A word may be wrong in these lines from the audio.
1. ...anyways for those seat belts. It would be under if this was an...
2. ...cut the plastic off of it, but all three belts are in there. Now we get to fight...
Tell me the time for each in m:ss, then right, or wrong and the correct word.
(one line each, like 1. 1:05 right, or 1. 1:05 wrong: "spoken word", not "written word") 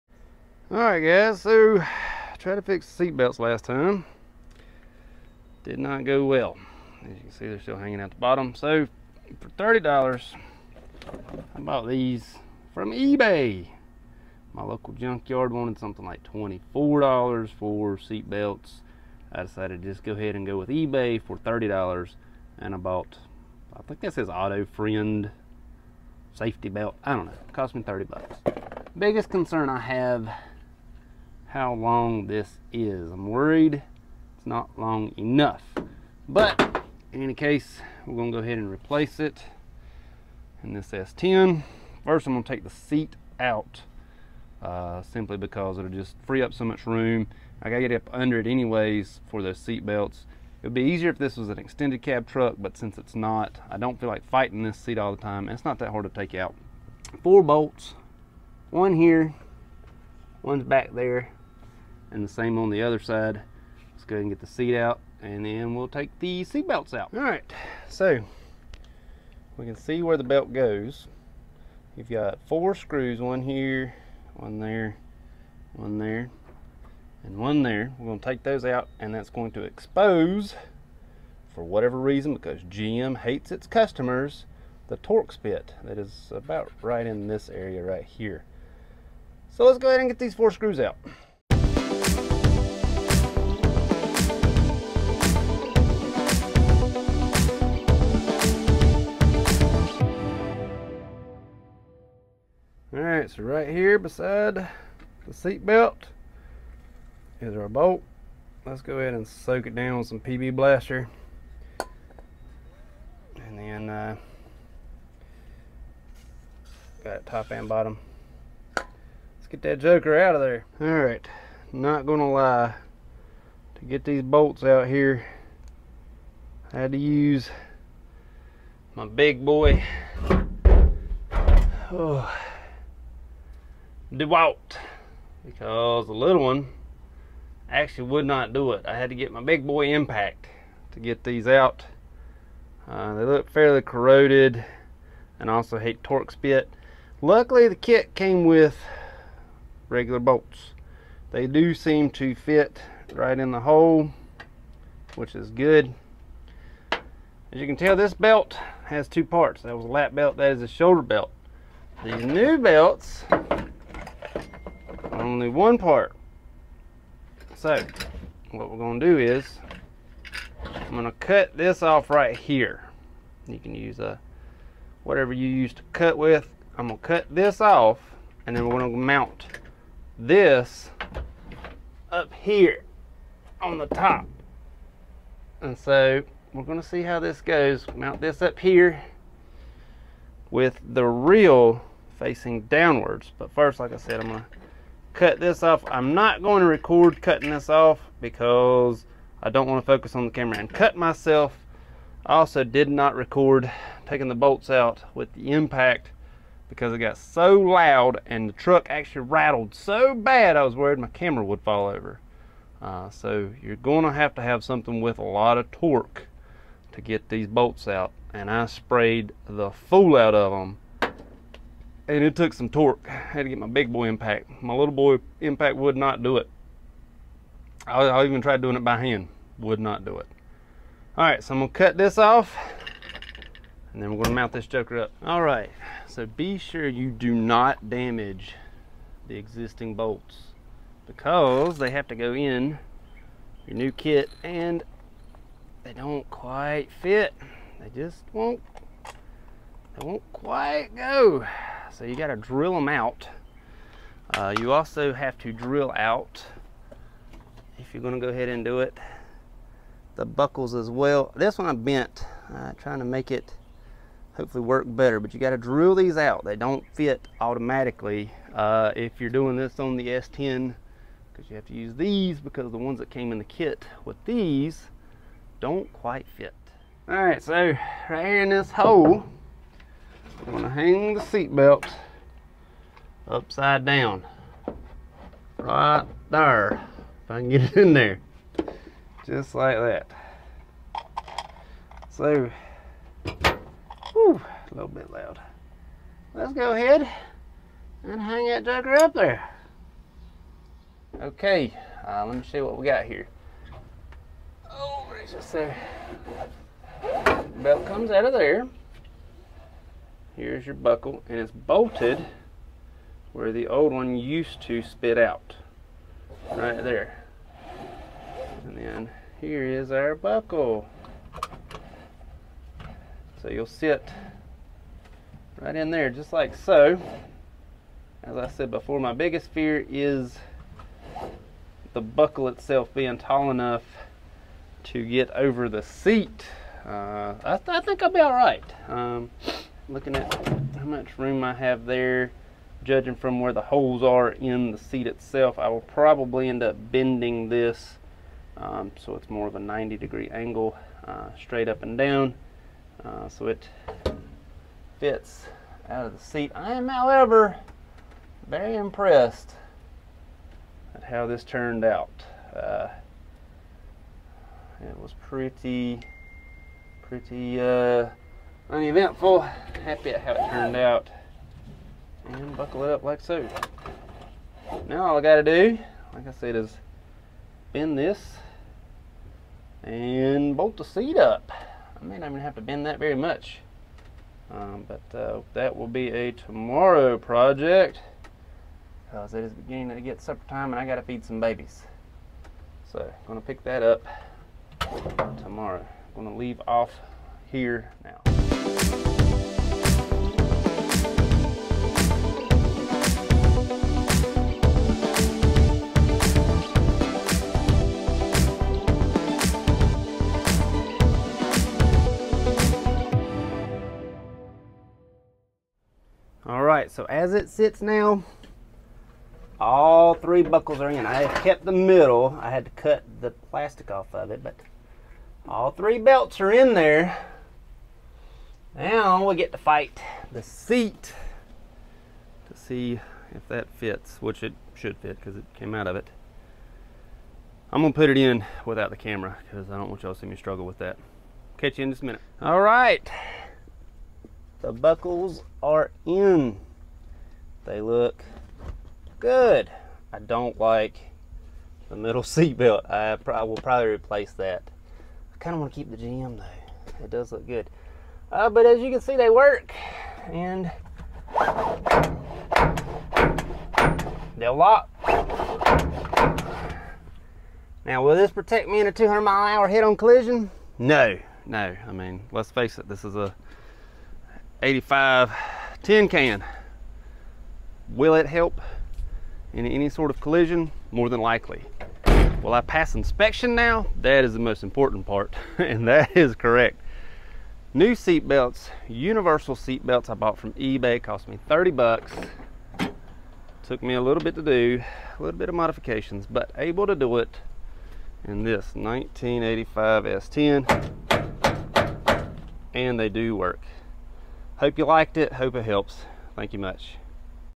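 1. 0:48 wrong: "easier", not "under"
2. 7:02 right.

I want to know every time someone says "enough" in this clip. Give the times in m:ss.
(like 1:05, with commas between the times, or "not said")
0:35, 5:33.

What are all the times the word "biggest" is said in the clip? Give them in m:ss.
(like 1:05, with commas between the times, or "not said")
0:28, 5:29.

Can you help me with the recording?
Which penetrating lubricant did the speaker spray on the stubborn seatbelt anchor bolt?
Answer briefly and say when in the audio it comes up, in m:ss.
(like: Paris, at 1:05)
PB Blaster, at 1:50.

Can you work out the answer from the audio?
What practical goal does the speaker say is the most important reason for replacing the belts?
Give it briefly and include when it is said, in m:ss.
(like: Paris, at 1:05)
pass inspection, at 8:02.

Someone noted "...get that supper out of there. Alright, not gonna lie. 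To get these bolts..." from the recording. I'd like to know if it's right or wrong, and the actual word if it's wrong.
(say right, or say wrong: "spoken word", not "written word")
wrong: "joker", not "supper".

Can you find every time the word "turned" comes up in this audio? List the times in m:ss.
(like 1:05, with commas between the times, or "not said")
6:01, 6:10.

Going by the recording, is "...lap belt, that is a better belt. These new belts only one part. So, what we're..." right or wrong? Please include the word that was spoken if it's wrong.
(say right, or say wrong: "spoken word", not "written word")
wrong: "shoulder", not "better".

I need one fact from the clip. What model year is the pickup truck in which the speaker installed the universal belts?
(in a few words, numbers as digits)
1985.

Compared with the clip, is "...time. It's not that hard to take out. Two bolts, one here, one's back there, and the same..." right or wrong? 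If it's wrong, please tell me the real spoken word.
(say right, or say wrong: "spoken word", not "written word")
wrong: "Four", not "Two".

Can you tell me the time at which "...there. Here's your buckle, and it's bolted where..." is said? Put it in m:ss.
5:08.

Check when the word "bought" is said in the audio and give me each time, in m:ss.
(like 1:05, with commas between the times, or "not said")
0:11, 0:22, 8:10.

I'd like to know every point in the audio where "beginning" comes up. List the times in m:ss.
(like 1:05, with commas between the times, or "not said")
6:29.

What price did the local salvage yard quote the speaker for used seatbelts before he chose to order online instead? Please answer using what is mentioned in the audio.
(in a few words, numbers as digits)
$24.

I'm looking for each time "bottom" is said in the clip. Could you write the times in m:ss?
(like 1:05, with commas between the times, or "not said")
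0:08, 1:57.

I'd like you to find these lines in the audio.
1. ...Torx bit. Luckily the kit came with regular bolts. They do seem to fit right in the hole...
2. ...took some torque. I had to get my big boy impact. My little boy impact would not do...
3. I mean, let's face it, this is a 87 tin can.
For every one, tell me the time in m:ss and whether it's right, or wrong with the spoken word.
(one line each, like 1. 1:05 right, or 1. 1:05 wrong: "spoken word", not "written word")
1. 2:26 right
2. 3:42 right
3. 7:51 wrong: "85", not "87".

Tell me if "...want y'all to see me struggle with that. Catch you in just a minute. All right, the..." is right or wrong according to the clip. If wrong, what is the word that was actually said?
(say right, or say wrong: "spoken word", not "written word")
right.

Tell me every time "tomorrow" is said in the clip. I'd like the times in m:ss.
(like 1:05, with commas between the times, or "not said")
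6:26, 6:35.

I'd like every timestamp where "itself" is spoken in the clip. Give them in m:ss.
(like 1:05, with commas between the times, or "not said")
5:32, 5:45.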